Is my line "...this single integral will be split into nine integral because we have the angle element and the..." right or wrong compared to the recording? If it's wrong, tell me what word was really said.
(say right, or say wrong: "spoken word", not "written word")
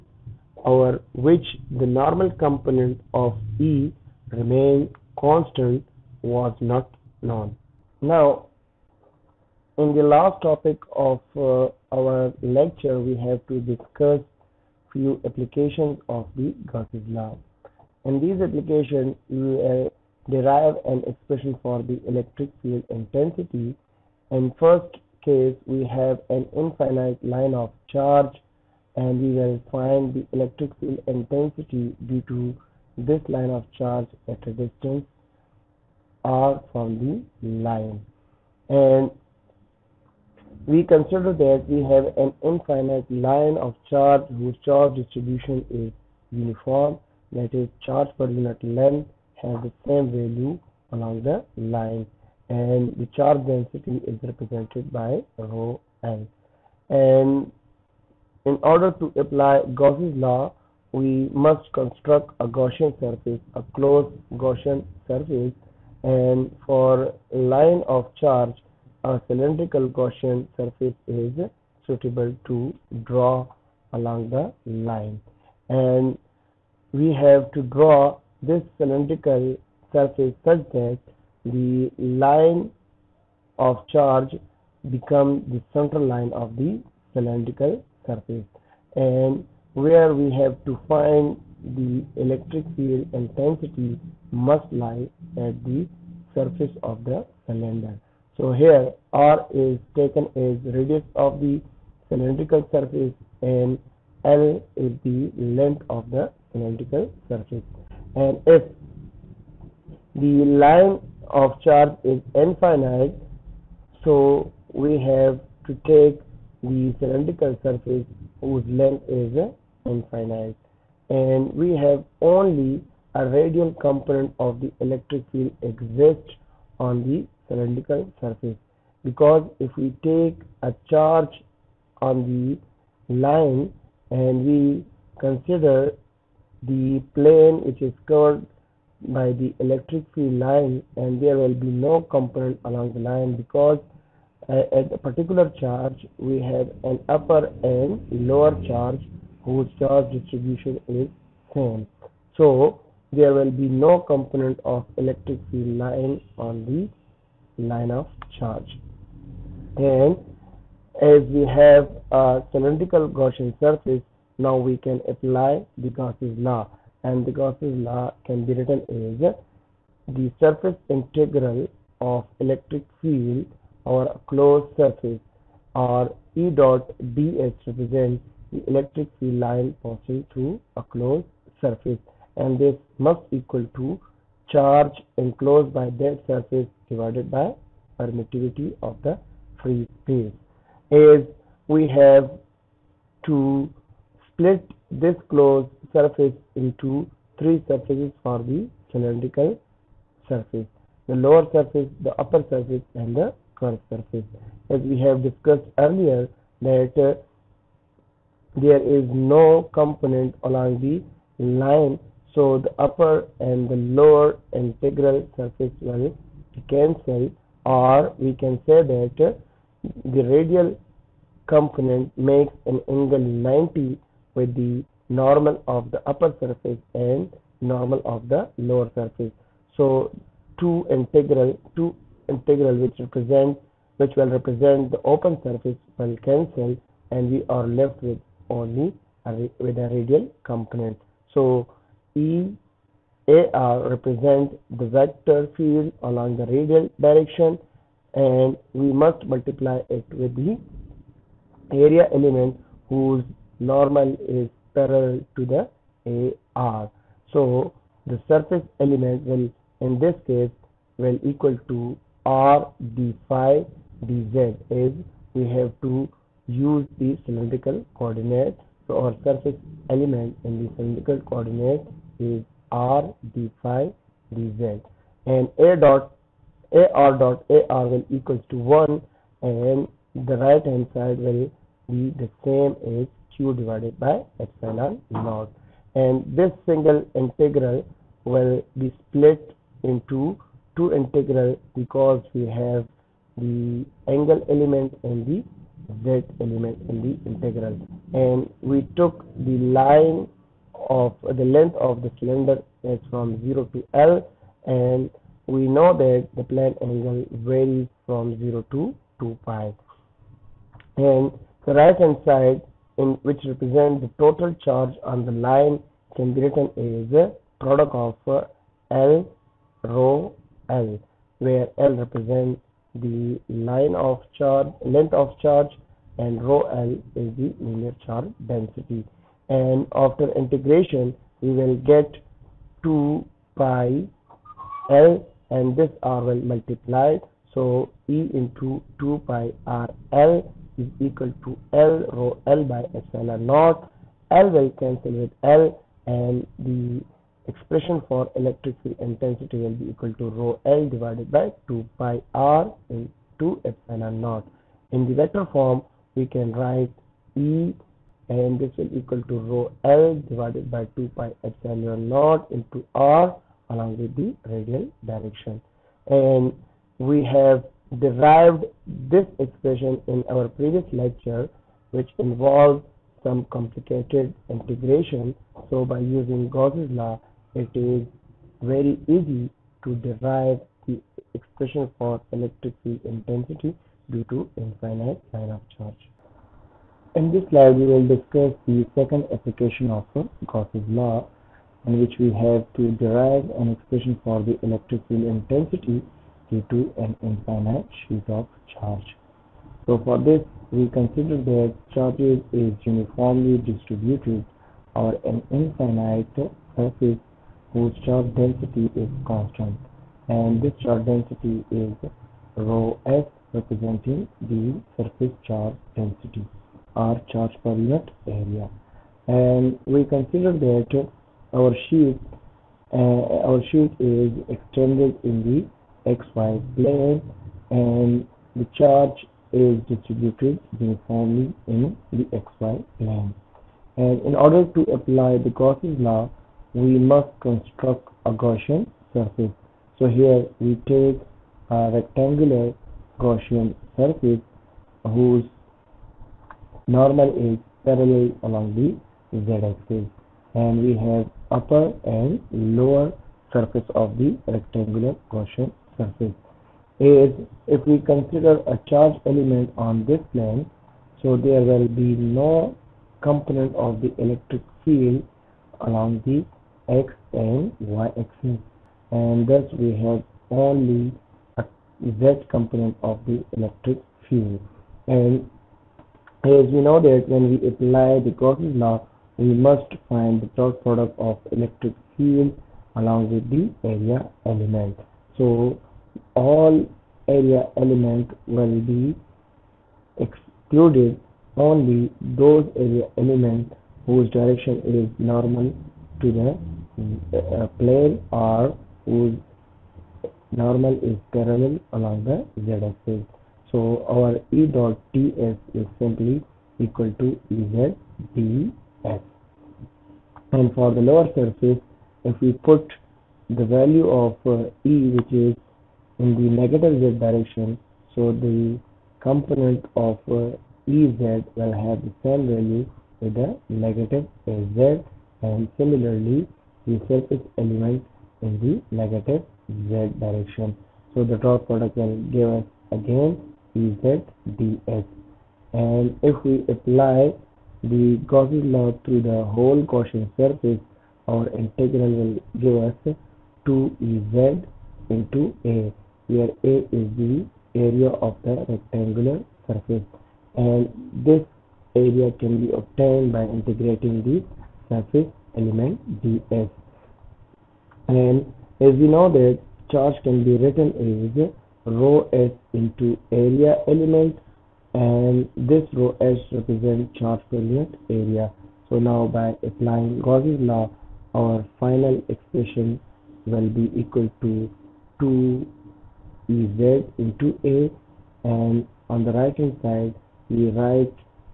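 wrong: "two", not "nine".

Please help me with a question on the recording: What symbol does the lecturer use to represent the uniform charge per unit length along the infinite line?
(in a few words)
rho n.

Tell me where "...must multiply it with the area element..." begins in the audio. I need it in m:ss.
4:08.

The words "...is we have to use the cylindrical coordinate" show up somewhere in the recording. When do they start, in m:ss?
4:24.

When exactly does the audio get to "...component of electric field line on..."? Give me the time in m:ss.
2:34.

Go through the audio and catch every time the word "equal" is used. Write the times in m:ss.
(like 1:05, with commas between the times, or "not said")
3:03, 4:21, 4:38, 5:41, 5:49, 5:58, 8:26, 9:34.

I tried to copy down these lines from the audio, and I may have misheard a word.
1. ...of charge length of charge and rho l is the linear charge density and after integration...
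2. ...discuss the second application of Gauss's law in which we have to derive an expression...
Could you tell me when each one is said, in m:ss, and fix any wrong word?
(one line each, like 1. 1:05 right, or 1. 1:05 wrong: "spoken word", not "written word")
1. 5:23 right
2. 6:28 right.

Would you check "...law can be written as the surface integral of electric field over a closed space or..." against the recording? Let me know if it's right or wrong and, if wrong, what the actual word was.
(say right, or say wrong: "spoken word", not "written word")
wrong: "surface", not "space".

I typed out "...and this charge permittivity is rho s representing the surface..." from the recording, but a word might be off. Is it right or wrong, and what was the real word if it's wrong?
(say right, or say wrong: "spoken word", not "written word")
wrong: "density", not "permittivity".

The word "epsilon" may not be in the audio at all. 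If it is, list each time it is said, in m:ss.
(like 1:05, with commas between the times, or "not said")
4:44, 5:43, 5:53, 6:01.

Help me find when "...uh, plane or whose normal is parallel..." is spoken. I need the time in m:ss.
8:17.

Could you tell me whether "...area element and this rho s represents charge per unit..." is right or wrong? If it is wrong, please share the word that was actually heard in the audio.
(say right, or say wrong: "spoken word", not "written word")
right.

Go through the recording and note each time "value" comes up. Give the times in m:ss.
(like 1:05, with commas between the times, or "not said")
0:50, 8:33, 8:42.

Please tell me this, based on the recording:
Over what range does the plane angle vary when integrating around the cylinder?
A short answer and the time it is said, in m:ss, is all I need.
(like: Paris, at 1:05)
0 to 2 pi, at 5:08.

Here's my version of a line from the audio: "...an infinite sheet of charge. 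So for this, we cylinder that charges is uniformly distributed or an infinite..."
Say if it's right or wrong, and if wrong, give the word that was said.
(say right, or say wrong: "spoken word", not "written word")
wrong: "consider", not "cylinder".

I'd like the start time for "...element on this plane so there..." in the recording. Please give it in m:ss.
7:39.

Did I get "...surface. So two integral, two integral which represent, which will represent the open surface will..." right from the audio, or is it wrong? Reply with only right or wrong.
right.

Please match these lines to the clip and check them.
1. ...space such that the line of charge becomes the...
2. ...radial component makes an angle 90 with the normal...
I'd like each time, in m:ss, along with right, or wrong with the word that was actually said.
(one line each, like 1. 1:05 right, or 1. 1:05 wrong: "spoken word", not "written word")
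1. 1:19 wrong: "surface", not "space"
2. 3:40 right.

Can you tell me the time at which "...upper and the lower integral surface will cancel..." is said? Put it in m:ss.
3:32.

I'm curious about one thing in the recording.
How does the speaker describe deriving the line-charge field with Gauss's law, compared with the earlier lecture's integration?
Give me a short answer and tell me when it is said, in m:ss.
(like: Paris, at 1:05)
very easy, at 6:18.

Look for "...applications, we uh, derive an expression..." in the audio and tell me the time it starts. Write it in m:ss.
0:18.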